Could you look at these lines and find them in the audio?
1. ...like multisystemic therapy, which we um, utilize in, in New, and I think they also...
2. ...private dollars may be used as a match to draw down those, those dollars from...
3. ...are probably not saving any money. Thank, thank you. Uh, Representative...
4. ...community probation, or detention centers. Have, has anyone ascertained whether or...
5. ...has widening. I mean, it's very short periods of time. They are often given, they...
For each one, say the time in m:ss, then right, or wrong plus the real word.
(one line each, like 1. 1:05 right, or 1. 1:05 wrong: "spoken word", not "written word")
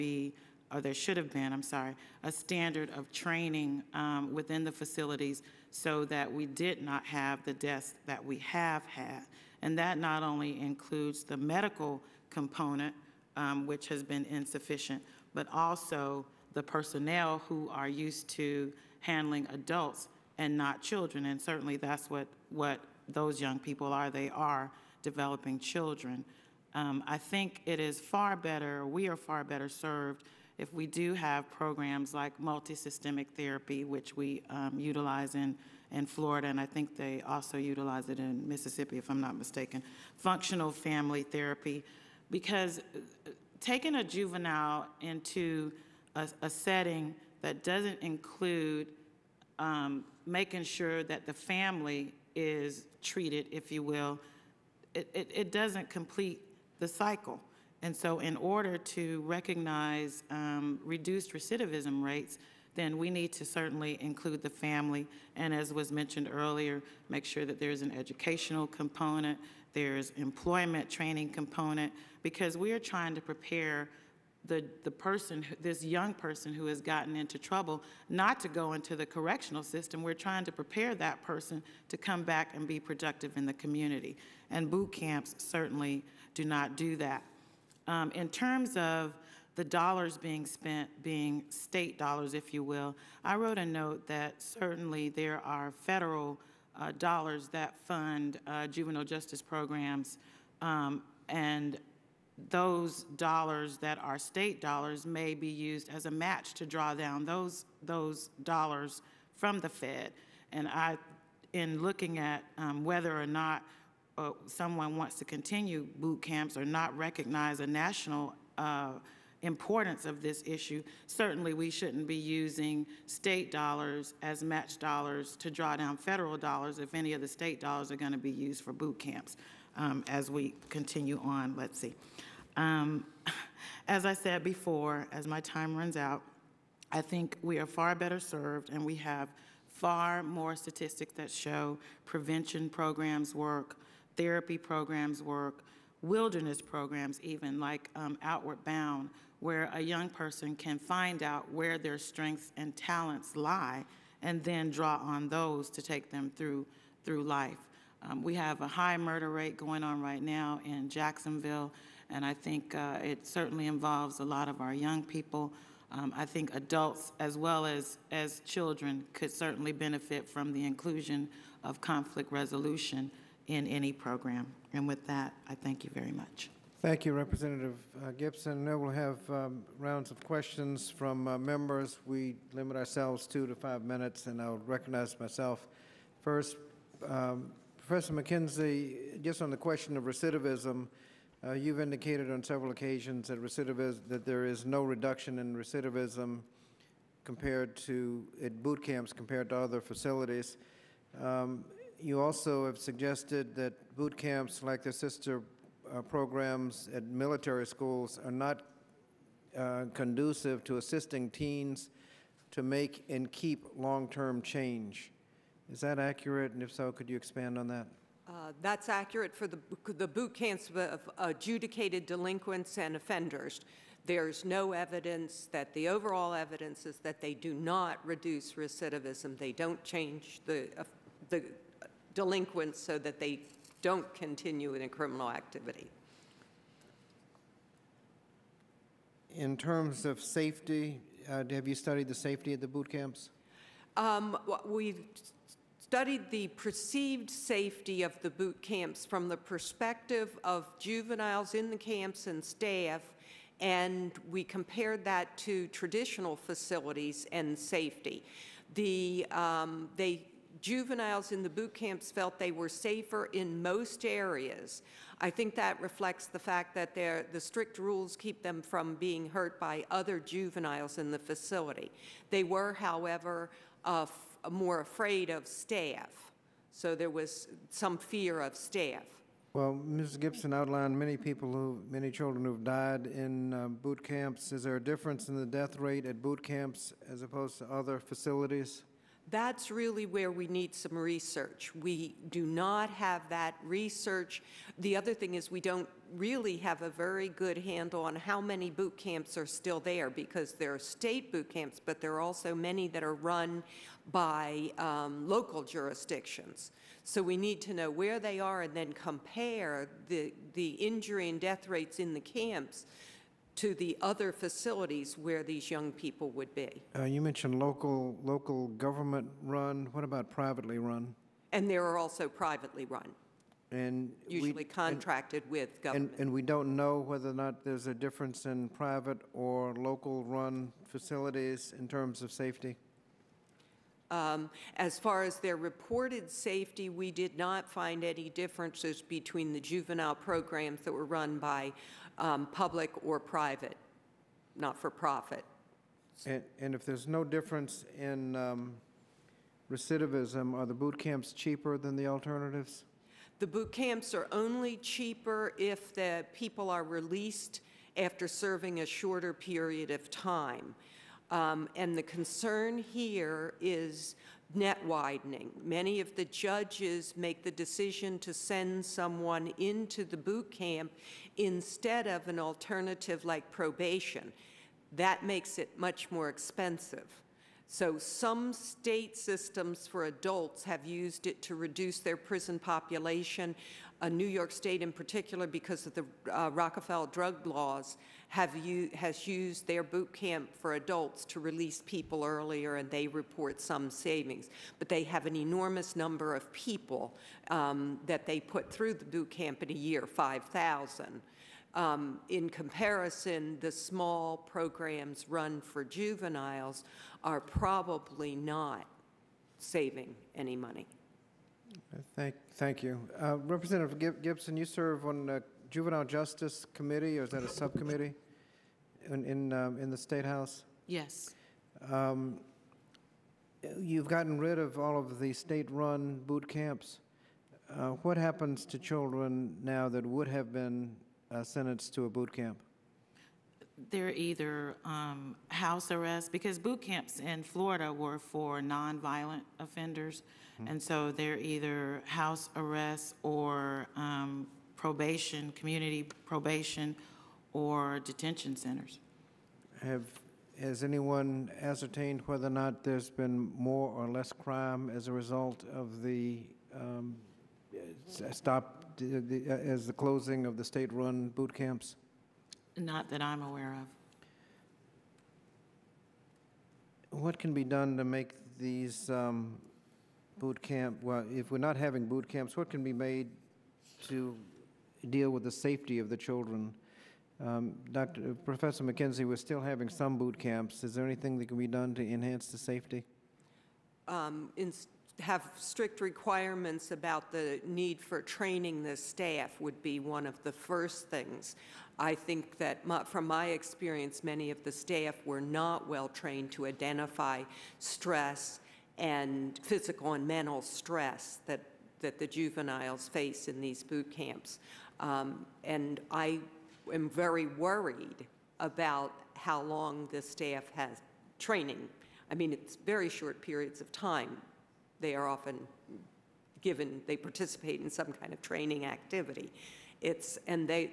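1. 0:32 wrong: "Florida", not "New"
2. 1:44 wrong: "state", not "private"
3. 6:47 right
4. 7:25 right
5. 8:30 wrong: "training", not "widening".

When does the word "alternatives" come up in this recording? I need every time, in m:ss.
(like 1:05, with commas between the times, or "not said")
5:52, 6:12.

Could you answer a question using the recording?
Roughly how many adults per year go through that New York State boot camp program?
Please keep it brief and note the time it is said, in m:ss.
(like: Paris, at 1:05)
5,000, at 6:40.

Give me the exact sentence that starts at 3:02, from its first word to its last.
We limit ourselves two to five minutes, and I'll recognize myself first.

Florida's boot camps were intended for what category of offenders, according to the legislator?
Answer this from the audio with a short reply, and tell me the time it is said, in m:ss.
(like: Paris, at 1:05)
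nonviolent offenders, at 7:18.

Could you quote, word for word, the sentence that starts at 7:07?
Uh, what happens to children now that would have been uh, sentenced to a boot camp?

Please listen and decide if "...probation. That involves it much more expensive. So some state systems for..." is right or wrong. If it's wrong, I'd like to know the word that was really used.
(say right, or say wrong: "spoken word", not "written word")
wrong: "makes", not "involves".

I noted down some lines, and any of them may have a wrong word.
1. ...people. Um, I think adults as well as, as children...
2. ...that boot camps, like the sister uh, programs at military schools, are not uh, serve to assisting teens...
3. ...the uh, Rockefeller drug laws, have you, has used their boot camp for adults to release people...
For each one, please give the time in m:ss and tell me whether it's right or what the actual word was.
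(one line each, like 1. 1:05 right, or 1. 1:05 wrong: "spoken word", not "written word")
1. 2:45 right
2. 3:23 wrong: "conducive", not "serve"
3. 6:25 right.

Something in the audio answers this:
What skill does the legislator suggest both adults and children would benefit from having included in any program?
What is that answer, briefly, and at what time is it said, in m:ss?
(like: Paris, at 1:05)
conflict resolution, at 2:51.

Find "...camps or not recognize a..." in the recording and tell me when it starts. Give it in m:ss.
1:56.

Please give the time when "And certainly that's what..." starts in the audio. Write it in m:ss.
0:21.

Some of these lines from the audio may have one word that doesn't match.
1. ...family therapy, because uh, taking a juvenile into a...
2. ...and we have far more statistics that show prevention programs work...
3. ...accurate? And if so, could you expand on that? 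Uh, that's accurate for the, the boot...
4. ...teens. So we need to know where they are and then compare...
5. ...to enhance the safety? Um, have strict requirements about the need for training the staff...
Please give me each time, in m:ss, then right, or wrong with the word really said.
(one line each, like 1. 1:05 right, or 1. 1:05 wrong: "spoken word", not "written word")
1. 0:40 right
2. 2:18 right
3. 3:35 right
4. 5:05 wrong: "jurisdictions", not "teens"
5. 8:01 right.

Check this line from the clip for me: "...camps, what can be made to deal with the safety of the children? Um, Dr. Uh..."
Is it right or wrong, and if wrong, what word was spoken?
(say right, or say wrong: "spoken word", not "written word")
right.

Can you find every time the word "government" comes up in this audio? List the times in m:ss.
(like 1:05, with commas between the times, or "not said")
5:18, 5:25.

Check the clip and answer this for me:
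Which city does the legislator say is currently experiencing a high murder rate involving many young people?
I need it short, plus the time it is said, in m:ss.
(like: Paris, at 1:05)
Jacksonville, at 2:40.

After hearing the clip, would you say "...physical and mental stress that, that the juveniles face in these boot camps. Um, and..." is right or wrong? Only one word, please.
right.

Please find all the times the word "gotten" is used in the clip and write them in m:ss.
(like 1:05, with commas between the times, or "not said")
1:16, 7:04.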